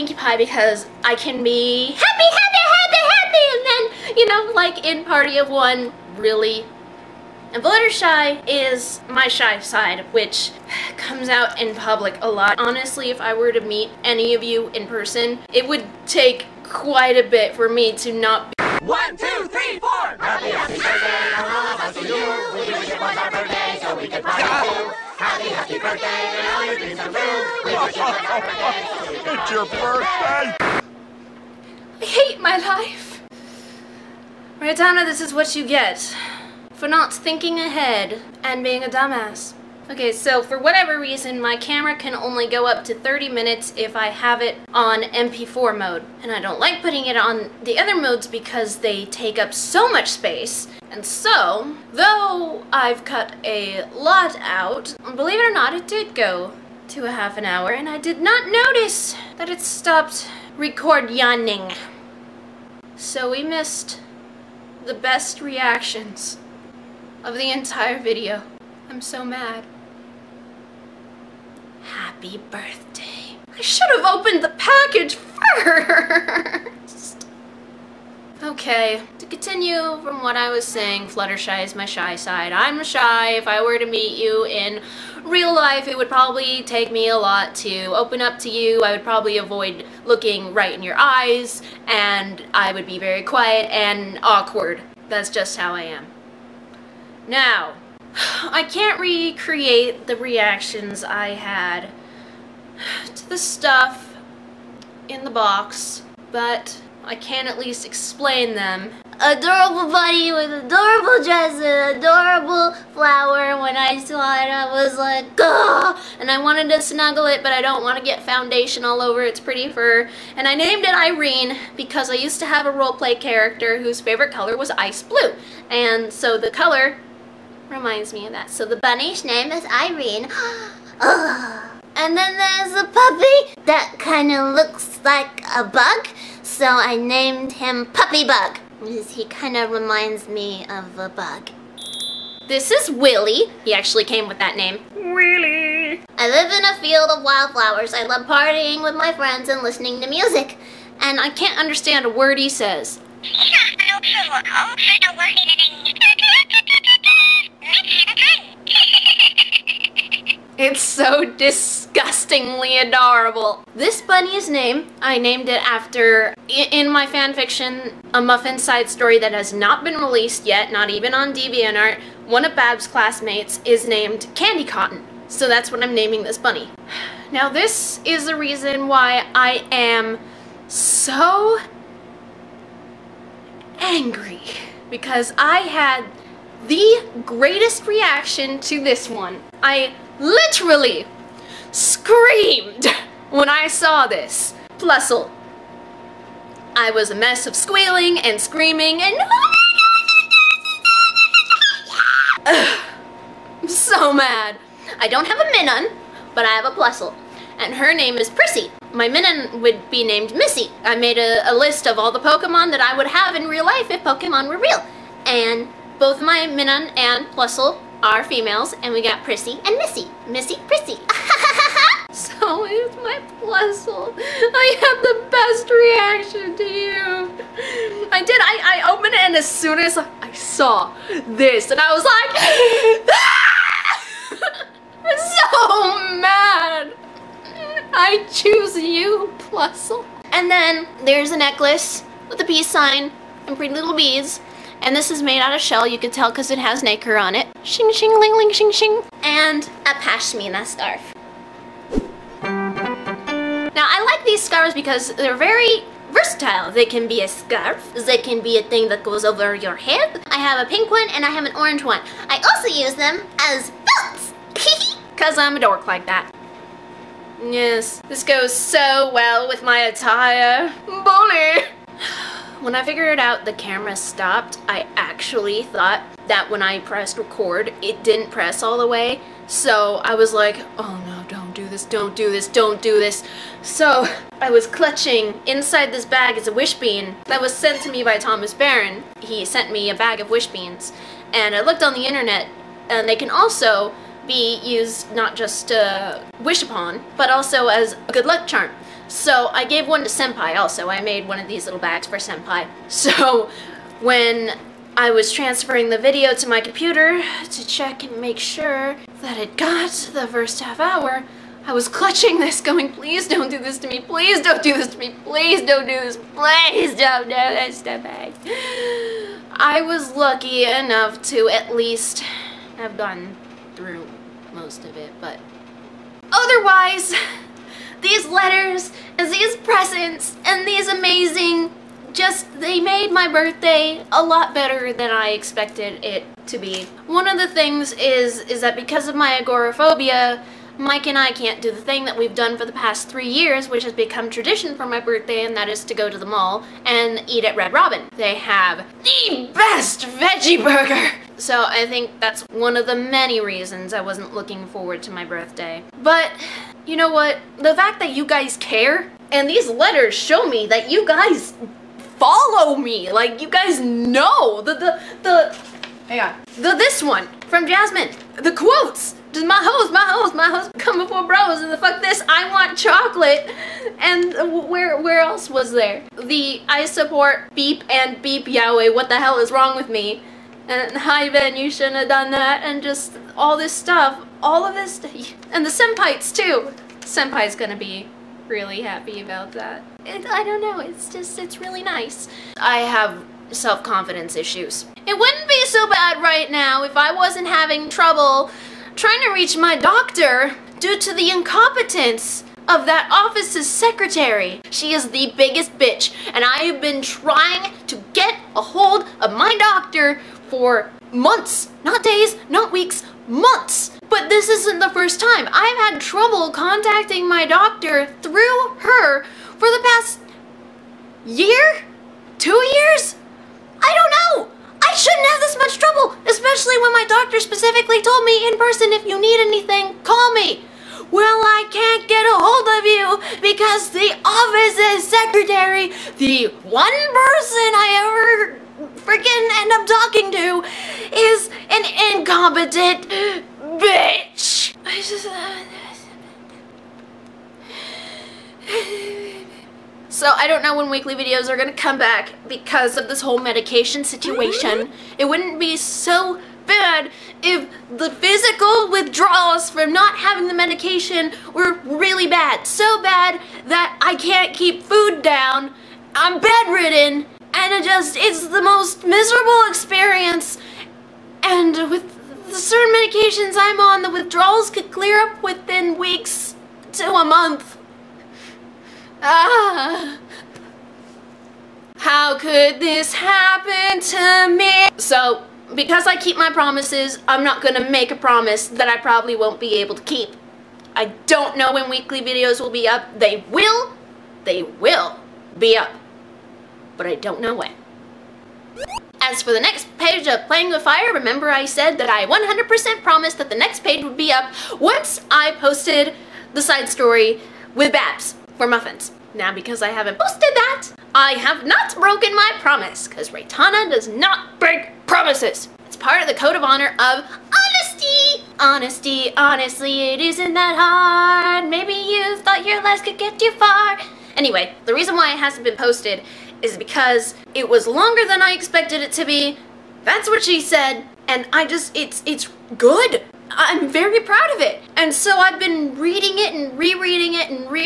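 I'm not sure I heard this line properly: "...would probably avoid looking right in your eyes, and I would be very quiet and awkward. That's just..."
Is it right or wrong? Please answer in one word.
right.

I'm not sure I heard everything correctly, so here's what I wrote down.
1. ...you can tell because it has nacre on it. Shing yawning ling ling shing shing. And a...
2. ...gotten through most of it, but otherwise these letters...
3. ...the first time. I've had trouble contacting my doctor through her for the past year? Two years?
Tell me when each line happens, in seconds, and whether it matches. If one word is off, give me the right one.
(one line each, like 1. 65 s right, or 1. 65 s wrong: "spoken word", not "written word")
1. 245 s wrong: "shing", not "yawning"
2. 322 s right
3. 414 s right.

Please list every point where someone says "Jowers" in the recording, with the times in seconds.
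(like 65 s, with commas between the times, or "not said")
not said.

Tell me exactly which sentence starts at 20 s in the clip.
Happy, happy birthday, all of us to you!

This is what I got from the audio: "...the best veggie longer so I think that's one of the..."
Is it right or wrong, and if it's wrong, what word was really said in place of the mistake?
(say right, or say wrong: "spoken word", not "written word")
wrong: "burger", not "longer".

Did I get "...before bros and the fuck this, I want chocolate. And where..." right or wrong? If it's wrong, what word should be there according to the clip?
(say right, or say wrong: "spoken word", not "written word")
right.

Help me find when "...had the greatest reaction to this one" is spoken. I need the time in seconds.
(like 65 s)
185 s.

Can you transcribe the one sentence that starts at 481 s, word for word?
How could this happen to me?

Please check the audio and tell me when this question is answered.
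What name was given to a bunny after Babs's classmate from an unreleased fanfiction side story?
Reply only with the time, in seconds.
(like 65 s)
174 s.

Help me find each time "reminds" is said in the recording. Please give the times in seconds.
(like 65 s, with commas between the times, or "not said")
127 s, 139 s.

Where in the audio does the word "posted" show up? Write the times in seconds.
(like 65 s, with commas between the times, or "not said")
505 s, 510 s, 525 s.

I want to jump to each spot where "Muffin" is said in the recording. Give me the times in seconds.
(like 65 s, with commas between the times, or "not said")
168 s, 508 s.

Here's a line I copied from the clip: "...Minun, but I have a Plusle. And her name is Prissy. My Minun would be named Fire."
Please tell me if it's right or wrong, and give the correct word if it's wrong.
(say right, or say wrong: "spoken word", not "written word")
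wrong: "Missy", not "Fire".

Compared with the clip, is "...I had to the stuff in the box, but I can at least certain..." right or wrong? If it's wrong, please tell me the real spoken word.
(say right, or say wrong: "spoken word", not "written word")
wrong: "explain", not "certain".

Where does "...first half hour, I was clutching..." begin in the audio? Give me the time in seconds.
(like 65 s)
310 s.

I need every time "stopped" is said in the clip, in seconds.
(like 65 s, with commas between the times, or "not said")
59 s, 273 s.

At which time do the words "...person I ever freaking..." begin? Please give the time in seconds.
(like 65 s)
436 s.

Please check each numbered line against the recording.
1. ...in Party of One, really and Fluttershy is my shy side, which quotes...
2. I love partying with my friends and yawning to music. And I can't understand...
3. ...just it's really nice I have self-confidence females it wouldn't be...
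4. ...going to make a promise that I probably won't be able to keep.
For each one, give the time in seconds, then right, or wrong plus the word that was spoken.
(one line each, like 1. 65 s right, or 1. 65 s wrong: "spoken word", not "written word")
1. 4 s wrong: "comes", not "quotes"
2. 147 s wrong: "listening", not "yawning"
3. 391 s wrong: "issues", not "females"
4. 487 s right.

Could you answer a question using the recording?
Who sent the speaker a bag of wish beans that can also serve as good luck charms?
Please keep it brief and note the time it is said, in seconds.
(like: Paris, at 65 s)
Thomas Barron, at 288 s.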